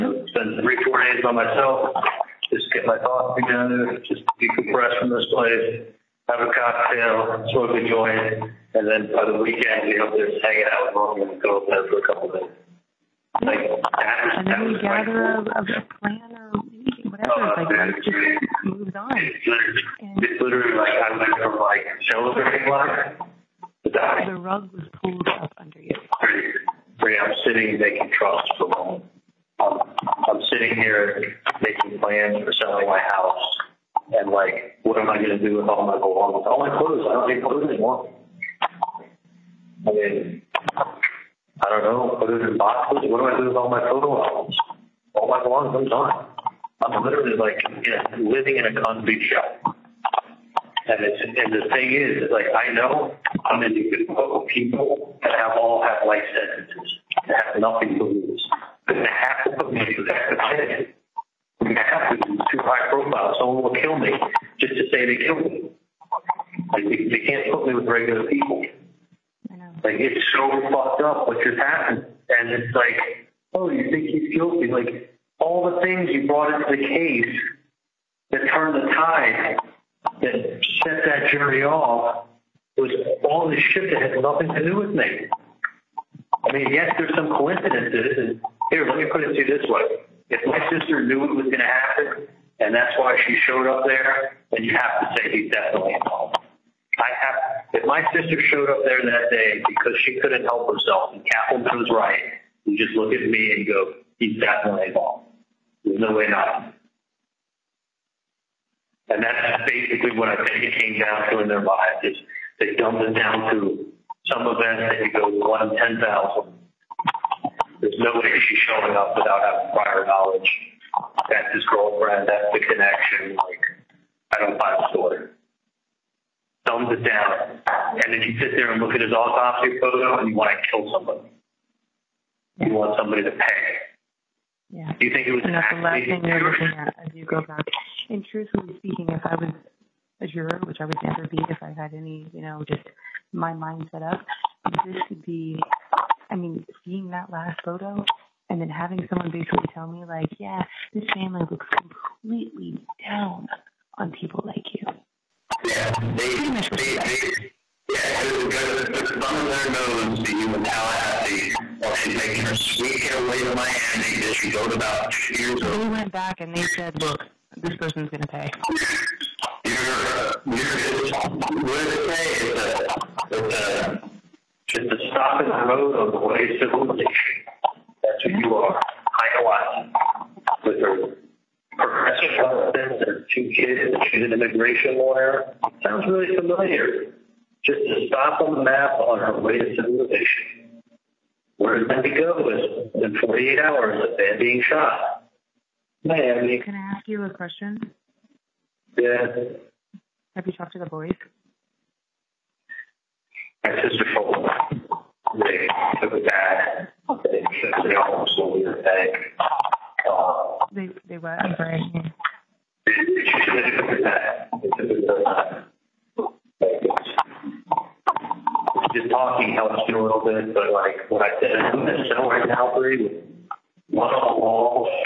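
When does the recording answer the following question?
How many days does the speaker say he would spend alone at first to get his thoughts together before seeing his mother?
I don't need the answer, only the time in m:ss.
0:00.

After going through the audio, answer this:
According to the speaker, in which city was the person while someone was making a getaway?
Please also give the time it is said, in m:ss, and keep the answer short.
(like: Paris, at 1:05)
Tallahassee, at 2:40.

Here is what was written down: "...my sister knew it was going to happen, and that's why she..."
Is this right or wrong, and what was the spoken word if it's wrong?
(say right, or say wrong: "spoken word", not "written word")
right.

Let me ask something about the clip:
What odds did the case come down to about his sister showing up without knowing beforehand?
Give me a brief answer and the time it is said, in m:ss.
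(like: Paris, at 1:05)
1 in 10,000, at 1:55.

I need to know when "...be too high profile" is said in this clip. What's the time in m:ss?
1:02.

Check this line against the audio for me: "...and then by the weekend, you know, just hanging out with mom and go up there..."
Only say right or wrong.
right.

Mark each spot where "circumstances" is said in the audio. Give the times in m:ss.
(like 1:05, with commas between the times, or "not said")
not said.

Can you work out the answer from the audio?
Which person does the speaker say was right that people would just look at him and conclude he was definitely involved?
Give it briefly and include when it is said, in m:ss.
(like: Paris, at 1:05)
Kaplan, at 1:41.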